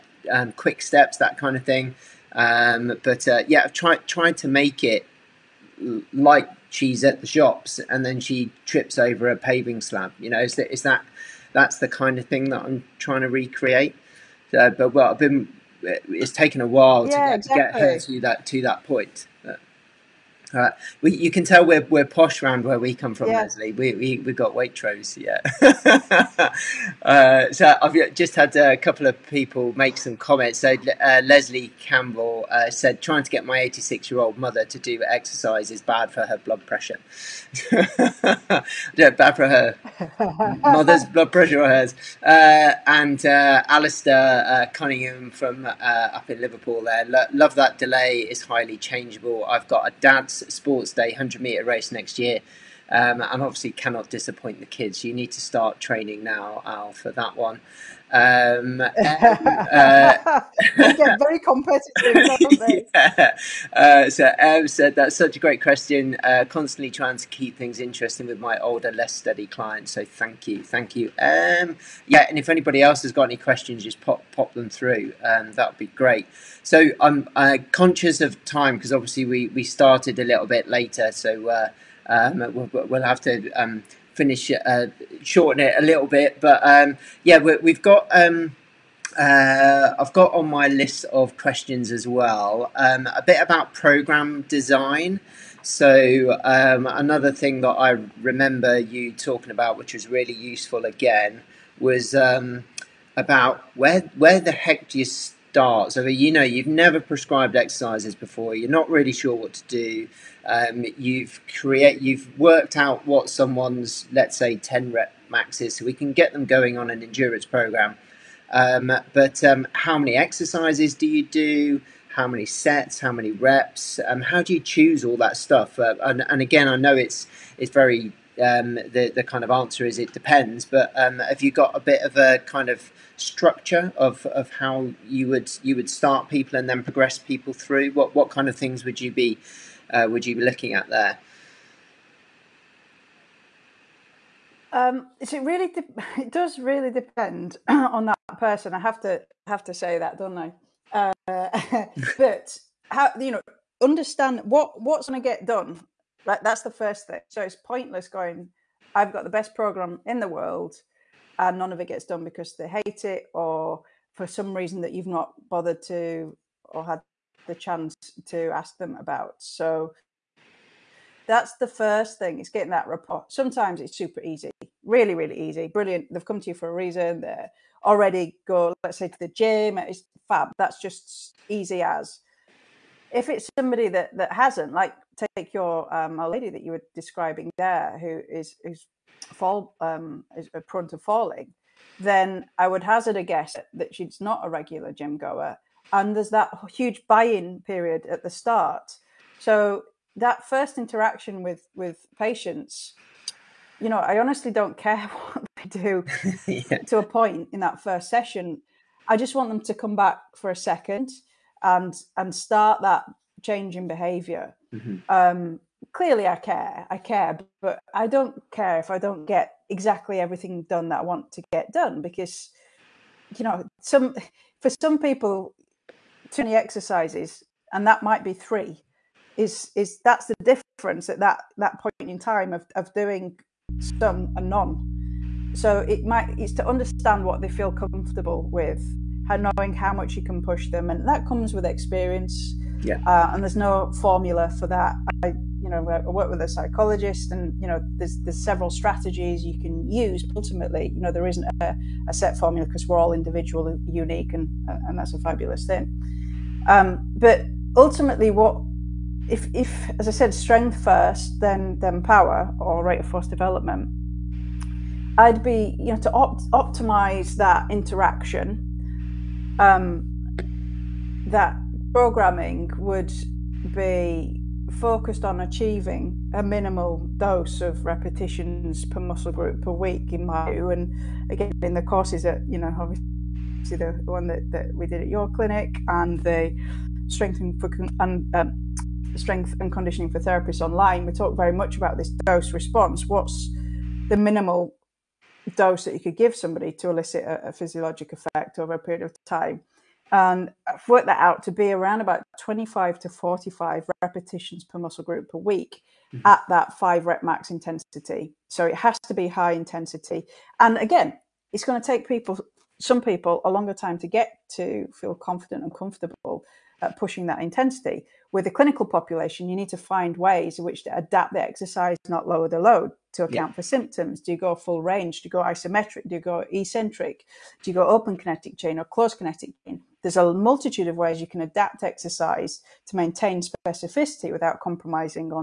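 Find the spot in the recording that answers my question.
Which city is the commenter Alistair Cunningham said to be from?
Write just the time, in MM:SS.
00:46.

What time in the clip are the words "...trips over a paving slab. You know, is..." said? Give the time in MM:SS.
00:08.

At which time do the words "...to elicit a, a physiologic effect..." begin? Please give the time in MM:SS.
04:56.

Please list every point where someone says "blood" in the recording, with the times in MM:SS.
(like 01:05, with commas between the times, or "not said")
00:36, 00:41.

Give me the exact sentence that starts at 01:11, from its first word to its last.
Um, yeah, and if anybody else has got any questions, just pop pop them through.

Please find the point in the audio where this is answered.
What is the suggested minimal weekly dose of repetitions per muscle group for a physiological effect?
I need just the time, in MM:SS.
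05:02.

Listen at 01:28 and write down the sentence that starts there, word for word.
Um, uh, I've got on my list of questions as well um, a bit about program design.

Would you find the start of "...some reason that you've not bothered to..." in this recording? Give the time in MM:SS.
02:44.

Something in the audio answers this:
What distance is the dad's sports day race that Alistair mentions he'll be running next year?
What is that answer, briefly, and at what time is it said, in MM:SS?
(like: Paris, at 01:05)
100 meters, at 00:51.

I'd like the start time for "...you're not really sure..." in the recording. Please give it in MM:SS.
01:48.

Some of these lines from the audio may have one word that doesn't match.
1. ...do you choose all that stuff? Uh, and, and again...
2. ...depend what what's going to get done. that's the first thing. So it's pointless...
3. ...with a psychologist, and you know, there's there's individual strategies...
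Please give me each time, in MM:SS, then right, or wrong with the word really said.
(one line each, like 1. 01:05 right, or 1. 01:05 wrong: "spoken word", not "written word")
1. 02:04 right
2. 02:33 wrong: "understand", not "depend"
3. 04:06 wrong: "several", not "individual".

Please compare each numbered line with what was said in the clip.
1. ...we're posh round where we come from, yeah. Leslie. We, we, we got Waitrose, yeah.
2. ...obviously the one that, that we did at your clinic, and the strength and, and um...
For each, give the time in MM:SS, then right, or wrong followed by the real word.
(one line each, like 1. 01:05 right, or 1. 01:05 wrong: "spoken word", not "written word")
1. 00:21 right
2. 04:43 right.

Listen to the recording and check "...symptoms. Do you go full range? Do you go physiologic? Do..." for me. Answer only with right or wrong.
wrong.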